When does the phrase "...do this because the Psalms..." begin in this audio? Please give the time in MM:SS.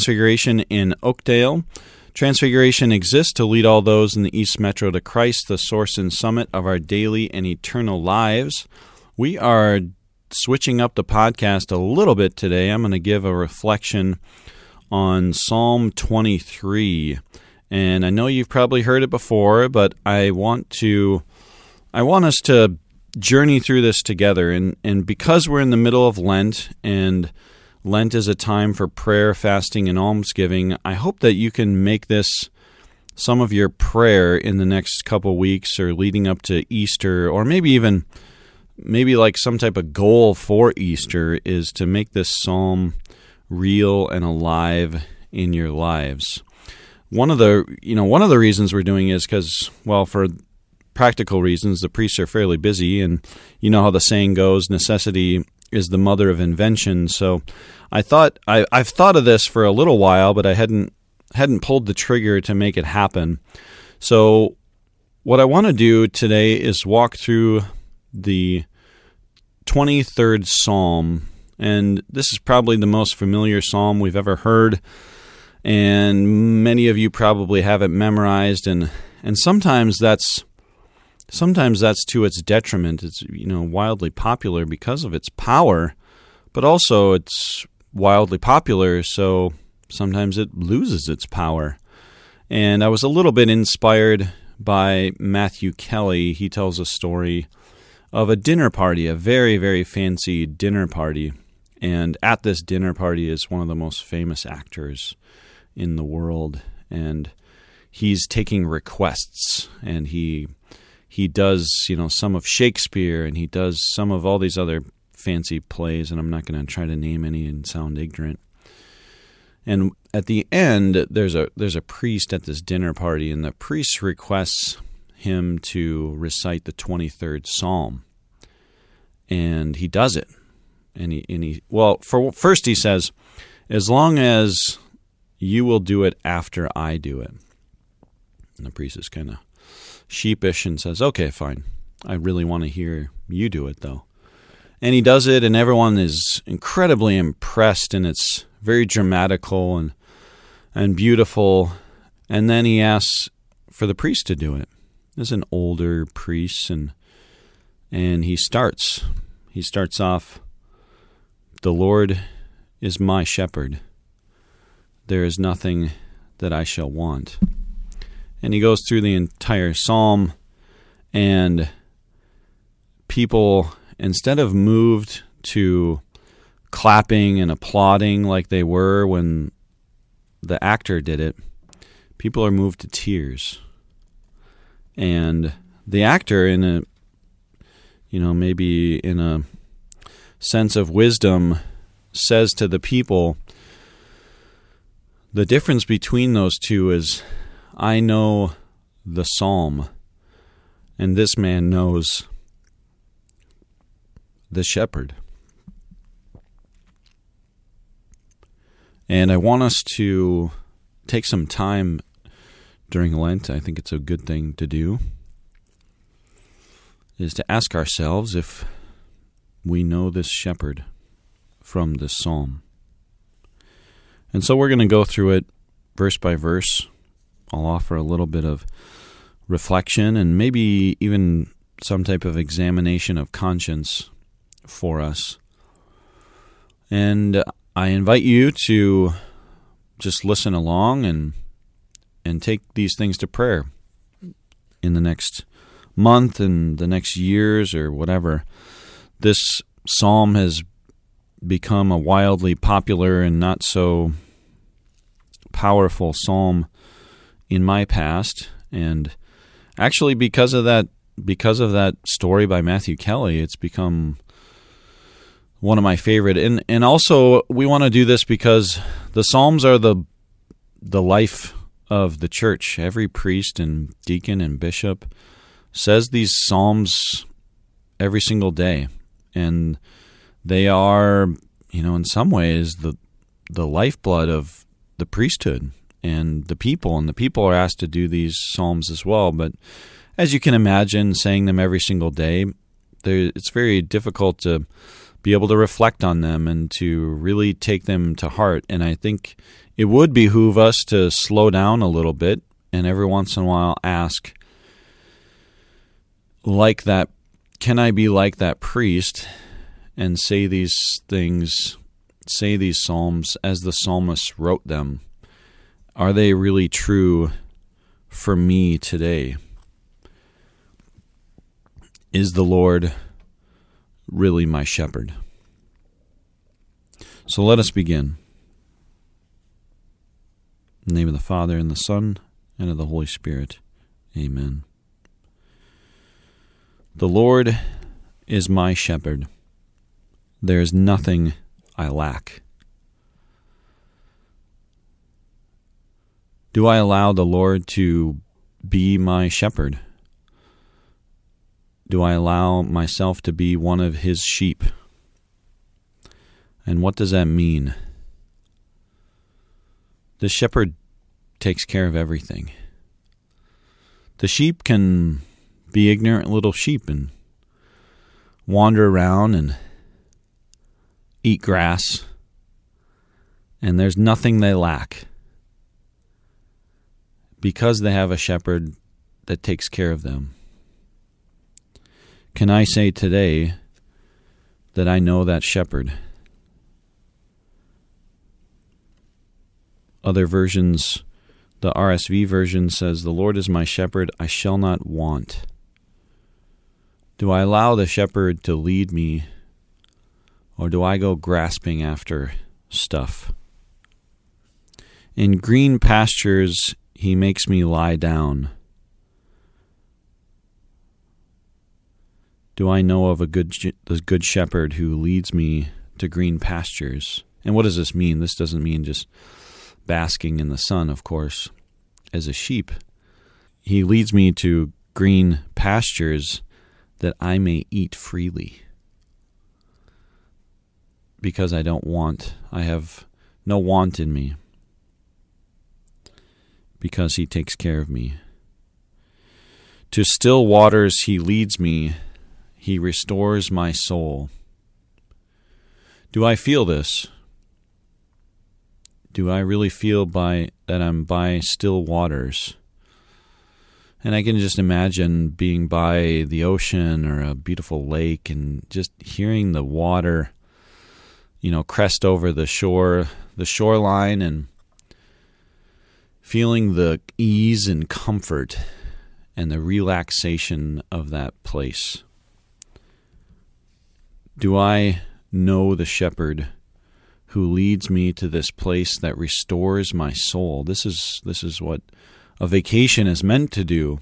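04:27.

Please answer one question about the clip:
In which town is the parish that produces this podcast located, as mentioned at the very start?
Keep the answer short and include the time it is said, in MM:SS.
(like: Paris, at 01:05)
Oakdale, at 00:01.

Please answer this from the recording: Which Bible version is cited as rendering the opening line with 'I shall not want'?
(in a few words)
RSV.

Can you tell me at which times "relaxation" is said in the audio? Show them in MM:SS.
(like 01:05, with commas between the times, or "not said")
07:49.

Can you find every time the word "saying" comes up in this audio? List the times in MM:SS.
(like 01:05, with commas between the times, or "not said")
00:53, 04:51.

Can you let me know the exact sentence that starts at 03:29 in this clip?
And I want us to take some time during Lent.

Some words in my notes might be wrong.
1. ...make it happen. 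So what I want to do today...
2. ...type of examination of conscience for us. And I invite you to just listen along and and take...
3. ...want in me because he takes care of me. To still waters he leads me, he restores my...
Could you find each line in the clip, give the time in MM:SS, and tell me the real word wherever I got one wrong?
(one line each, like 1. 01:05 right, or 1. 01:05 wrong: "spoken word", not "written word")
1. 01:02 right
2. 03:52 right
3. 07:13 right.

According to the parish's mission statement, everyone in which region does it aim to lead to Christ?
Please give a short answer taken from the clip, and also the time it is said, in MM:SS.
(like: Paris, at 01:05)
East Metro, at 00:04.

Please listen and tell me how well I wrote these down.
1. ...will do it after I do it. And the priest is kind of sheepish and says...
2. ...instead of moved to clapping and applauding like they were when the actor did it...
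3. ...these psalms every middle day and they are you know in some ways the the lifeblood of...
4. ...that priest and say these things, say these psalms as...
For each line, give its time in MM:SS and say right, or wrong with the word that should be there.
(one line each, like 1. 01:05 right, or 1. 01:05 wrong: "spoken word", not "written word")
1. 02:15 right
2. 02:53 right
3. 04:36 wrong: "single", not "middle"
4. 05:08 right.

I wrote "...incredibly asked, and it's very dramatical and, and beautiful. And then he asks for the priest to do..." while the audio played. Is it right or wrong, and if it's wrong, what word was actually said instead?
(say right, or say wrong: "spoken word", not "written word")
wrong: "impressed", not "asked".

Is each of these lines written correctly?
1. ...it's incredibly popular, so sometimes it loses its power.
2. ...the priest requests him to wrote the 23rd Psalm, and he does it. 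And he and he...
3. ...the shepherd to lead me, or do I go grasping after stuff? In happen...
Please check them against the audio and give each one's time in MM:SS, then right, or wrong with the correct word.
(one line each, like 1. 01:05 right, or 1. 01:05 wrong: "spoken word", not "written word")
1. 01:27 wrong: "wildly", not "incredibly"
2. 02:03 wrong: "recite", not "wrote"
3. 06:37 wrong: "green", not "happen".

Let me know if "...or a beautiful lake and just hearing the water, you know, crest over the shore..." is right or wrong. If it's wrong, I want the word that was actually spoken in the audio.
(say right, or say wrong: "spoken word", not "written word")
right.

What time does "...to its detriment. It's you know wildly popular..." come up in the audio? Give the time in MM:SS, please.
01:22.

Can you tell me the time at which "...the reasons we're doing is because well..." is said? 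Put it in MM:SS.
00:48.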